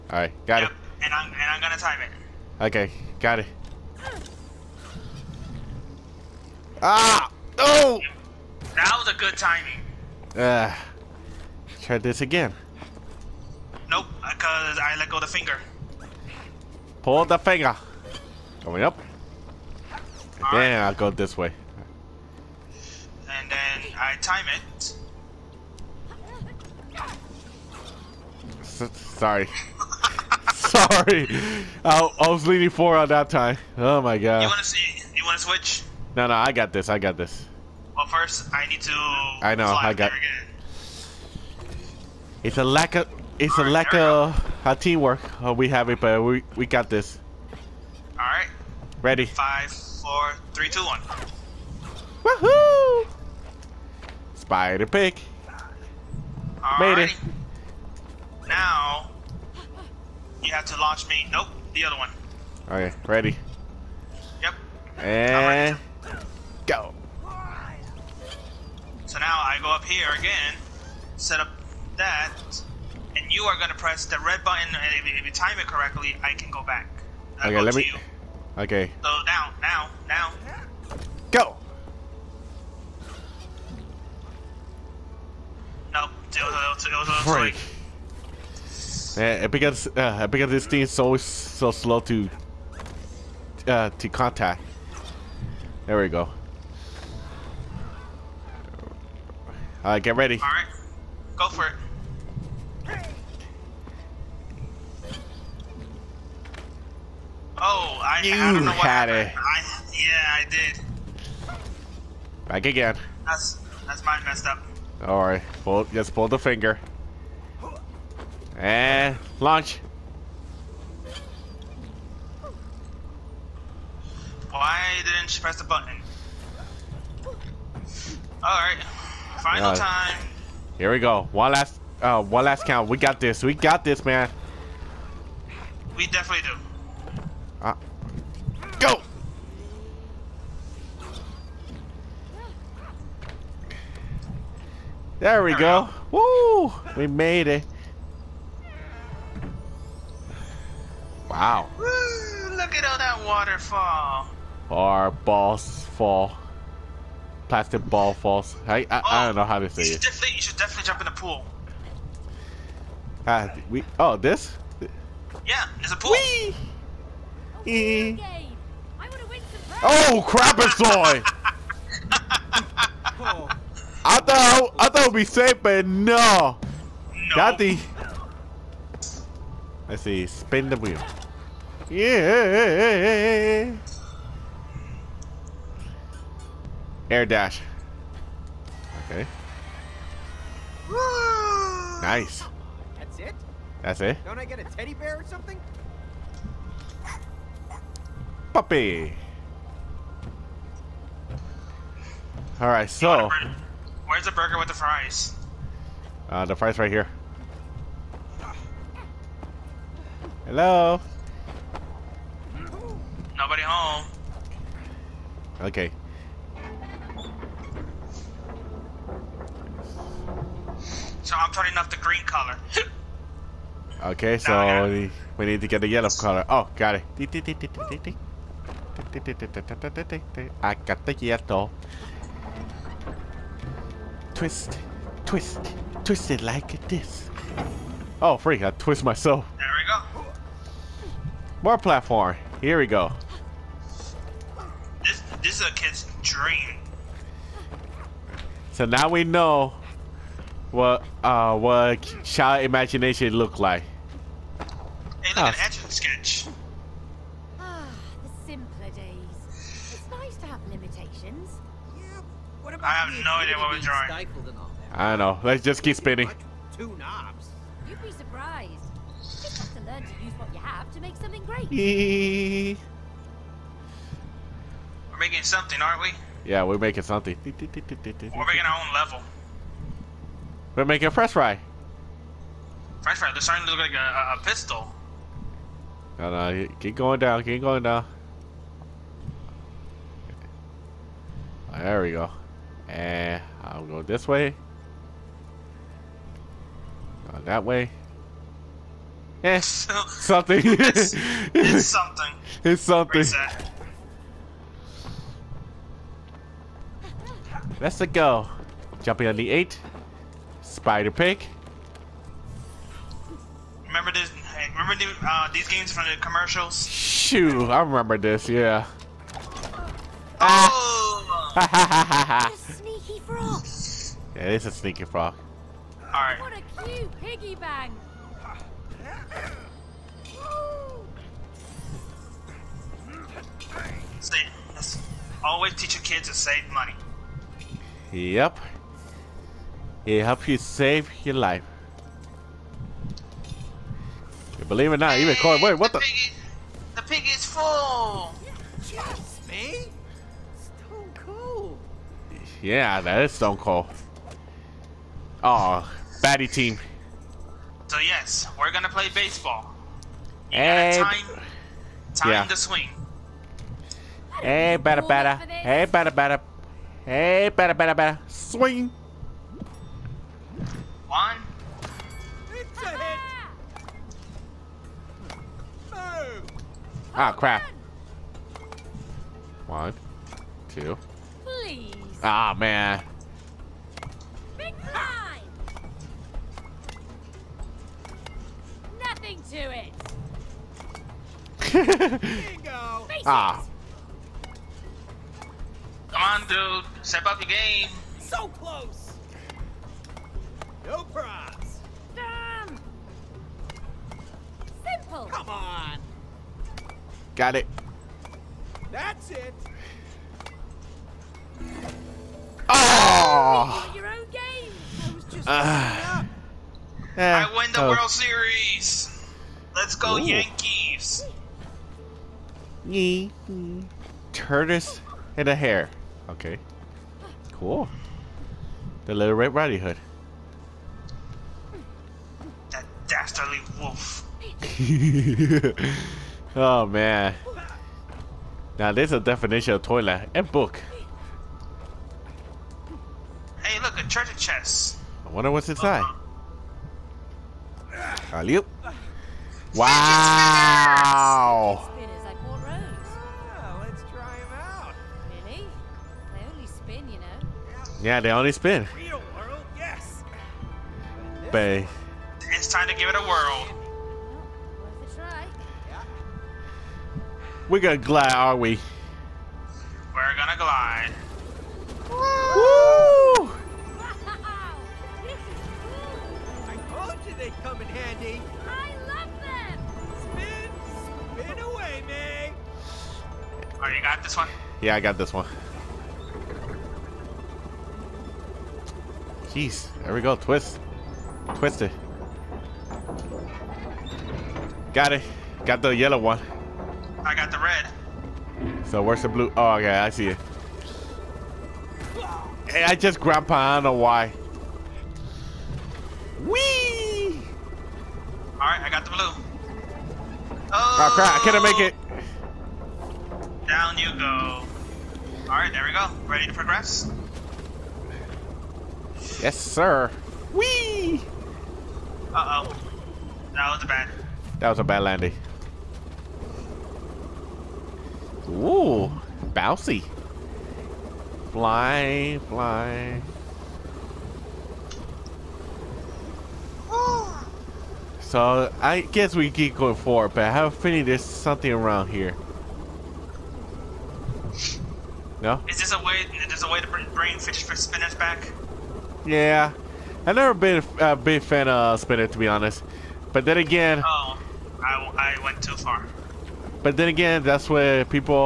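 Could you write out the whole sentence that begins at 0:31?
I, I, was leading four on that time.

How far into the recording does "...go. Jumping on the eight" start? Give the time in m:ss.
5:08.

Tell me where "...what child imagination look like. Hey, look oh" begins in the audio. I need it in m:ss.
4:11.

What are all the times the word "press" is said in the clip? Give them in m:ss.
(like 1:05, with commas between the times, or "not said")
1:13, 2:05.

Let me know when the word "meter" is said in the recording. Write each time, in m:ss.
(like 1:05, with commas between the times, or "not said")
not said.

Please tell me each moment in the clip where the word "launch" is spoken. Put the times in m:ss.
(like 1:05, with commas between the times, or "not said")
1:00, 1:59.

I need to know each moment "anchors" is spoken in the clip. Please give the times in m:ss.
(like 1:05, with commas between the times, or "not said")
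not said.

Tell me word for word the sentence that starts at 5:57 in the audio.
So yes, we're gonna play baseball.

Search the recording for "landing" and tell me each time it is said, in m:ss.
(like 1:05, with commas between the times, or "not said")
8:45.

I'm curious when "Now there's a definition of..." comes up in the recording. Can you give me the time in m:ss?
7:18.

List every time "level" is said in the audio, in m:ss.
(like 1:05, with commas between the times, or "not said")
4:38.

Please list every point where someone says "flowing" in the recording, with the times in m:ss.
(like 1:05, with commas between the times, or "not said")
not said.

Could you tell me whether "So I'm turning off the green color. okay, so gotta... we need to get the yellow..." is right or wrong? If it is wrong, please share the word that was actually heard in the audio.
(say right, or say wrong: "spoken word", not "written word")
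right.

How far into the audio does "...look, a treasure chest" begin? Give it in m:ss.
7:23.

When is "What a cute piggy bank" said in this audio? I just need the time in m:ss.
5:26.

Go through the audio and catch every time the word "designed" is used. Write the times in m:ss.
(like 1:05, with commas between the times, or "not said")
not said.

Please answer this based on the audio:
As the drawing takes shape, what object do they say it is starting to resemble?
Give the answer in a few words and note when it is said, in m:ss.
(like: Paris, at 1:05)
a pistol, at 4:44.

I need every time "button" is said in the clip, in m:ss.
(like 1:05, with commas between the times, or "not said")
1:14, 2:05.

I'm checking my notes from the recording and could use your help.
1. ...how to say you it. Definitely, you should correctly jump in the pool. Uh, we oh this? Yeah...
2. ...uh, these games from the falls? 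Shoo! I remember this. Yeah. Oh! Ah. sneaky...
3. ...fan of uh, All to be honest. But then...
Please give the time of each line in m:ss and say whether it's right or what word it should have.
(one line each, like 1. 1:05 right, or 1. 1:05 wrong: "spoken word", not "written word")
1. 2:39 wrong: "definitely", not "correctly"
2. 5:15 wrong: "commercials", not "falls"
3. 9:11 wrong: "Spinner", not "All".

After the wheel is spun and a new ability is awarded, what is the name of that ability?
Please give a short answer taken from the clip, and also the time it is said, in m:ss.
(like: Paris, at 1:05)
Air dash, at 3:07.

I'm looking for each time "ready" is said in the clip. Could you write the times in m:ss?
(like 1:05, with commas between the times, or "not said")
0:49, 1:03, 1:40, 8:36.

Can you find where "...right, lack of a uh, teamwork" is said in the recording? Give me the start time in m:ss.
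0:43.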